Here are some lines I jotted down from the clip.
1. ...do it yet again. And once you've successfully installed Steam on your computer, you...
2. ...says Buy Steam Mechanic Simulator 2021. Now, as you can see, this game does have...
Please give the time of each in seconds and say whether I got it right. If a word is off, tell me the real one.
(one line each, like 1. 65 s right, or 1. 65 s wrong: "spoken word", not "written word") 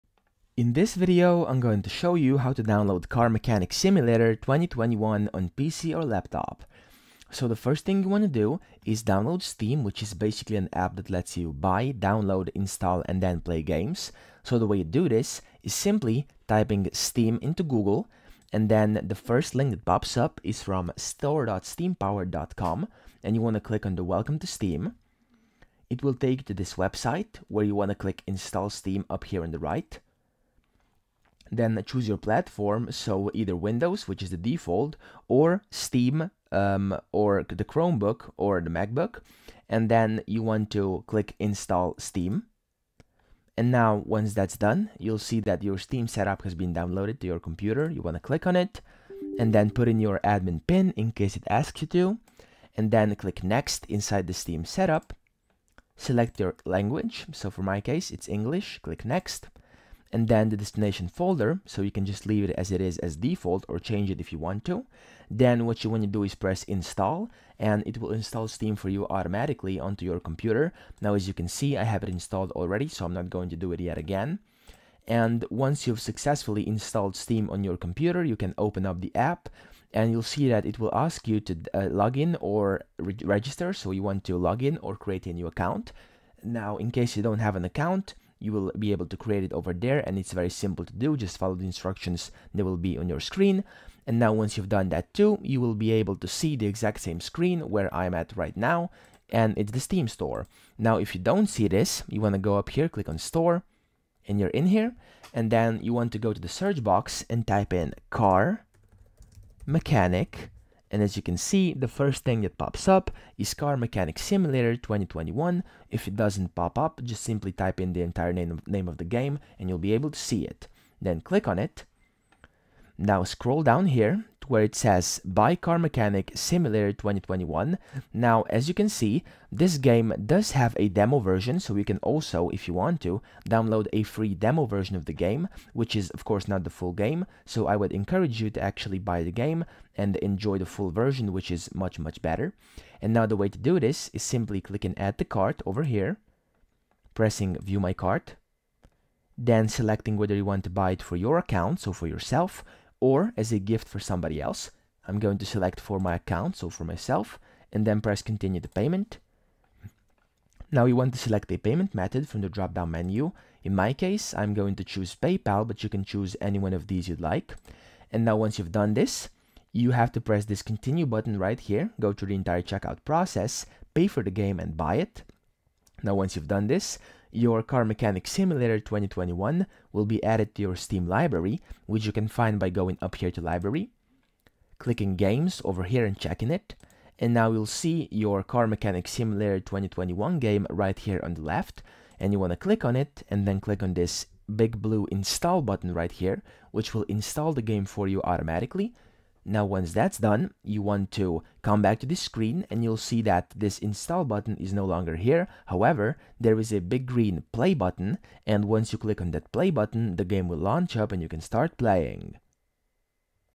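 1. 73 s right
2. 124 s wrong: "Car", not "Steam".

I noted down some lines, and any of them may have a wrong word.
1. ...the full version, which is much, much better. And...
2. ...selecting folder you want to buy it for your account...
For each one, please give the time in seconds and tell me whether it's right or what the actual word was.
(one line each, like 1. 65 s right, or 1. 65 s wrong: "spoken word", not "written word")
1. 140 s right
2. 149 s wrong: "whether", not "folder".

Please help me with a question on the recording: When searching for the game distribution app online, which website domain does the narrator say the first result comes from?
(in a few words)
store.steampower.com.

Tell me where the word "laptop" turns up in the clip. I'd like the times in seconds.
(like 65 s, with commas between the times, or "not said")
6 s.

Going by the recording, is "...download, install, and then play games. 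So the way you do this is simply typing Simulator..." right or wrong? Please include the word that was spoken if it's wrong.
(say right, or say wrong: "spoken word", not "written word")
wrong: "Steam", not "Simulator".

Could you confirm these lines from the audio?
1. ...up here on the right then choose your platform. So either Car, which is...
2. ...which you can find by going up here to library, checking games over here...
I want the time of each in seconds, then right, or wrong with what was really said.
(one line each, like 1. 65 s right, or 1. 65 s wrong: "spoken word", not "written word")
1. 29 s wrong: "Windows", not "Car"
2. 181 s wrong: "clicking", not "checking".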